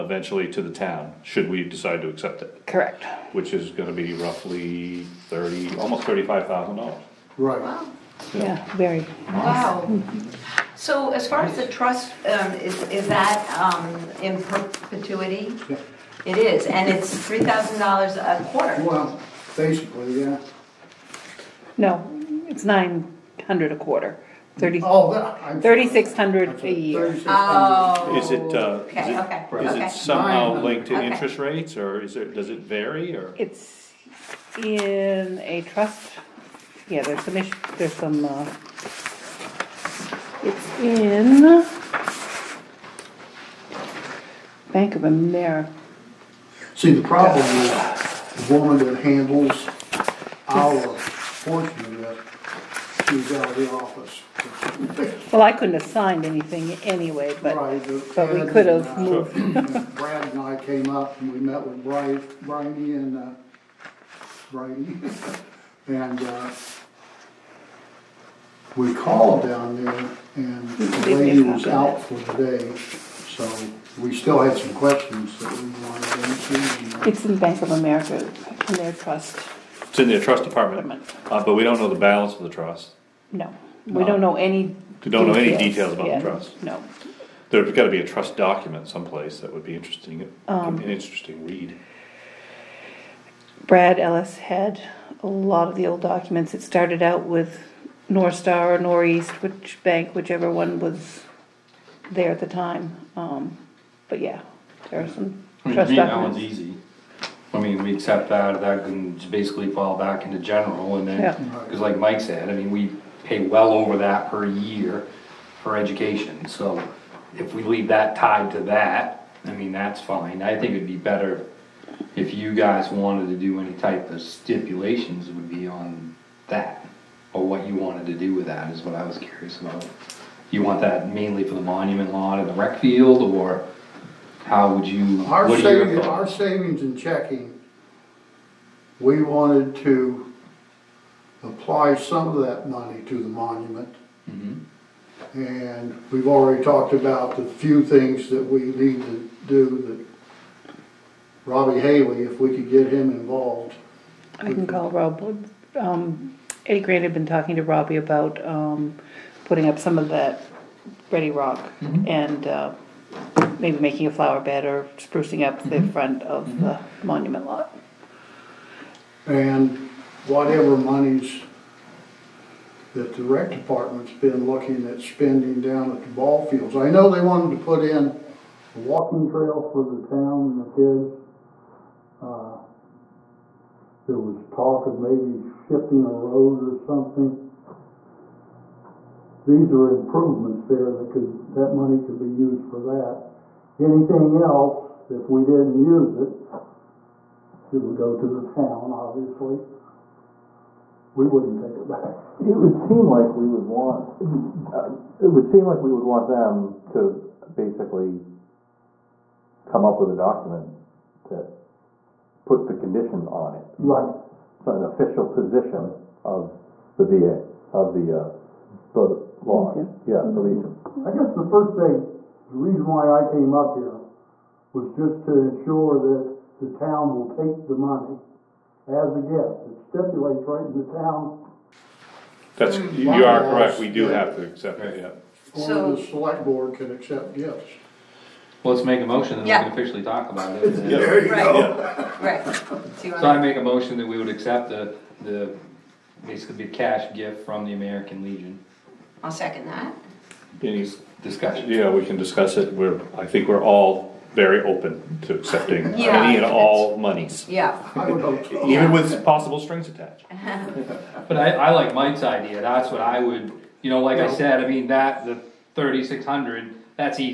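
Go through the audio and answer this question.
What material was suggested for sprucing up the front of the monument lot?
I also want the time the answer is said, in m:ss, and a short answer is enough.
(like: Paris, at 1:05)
ready rock, at 2:41.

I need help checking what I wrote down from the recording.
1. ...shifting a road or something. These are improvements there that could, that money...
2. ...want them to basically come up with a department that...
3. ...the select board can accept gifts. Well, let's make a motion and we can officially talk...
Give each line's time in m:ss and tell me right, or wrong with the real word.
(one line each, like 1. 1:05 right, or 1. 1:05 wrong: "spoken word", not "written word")
1. 3:05 right
2. 3:26 wrong: "document", not "department"
3. 3:55 right.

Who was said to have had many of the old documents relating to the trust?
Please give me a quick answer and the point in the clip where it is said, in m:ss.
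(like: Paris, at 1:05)
Brad Ellis, at 1:33.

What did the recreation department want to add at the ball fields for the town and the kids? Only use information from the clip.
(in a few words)
a walking trail.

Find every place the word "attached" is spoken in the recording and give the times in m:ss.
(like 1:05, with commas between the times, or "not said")
4:19.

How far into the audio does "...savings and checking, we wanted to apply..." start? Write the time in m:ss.
2:16.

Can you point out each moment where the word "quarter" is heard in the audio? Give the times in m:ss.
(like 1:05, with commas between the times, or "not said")
0:18, 0:23.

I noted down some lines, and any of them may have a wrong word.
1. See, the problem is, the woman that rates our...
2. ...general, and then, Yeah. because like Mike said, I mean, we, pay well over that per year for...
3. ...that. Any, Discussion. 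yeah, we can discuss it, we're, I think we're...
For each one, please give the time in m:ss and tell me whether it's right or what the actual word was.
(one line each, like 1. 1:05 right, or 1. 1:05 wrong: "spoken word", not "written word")
1. 0:46 wrong: "handles", not "rates"
2. 1:50 right
3. 4:09 right.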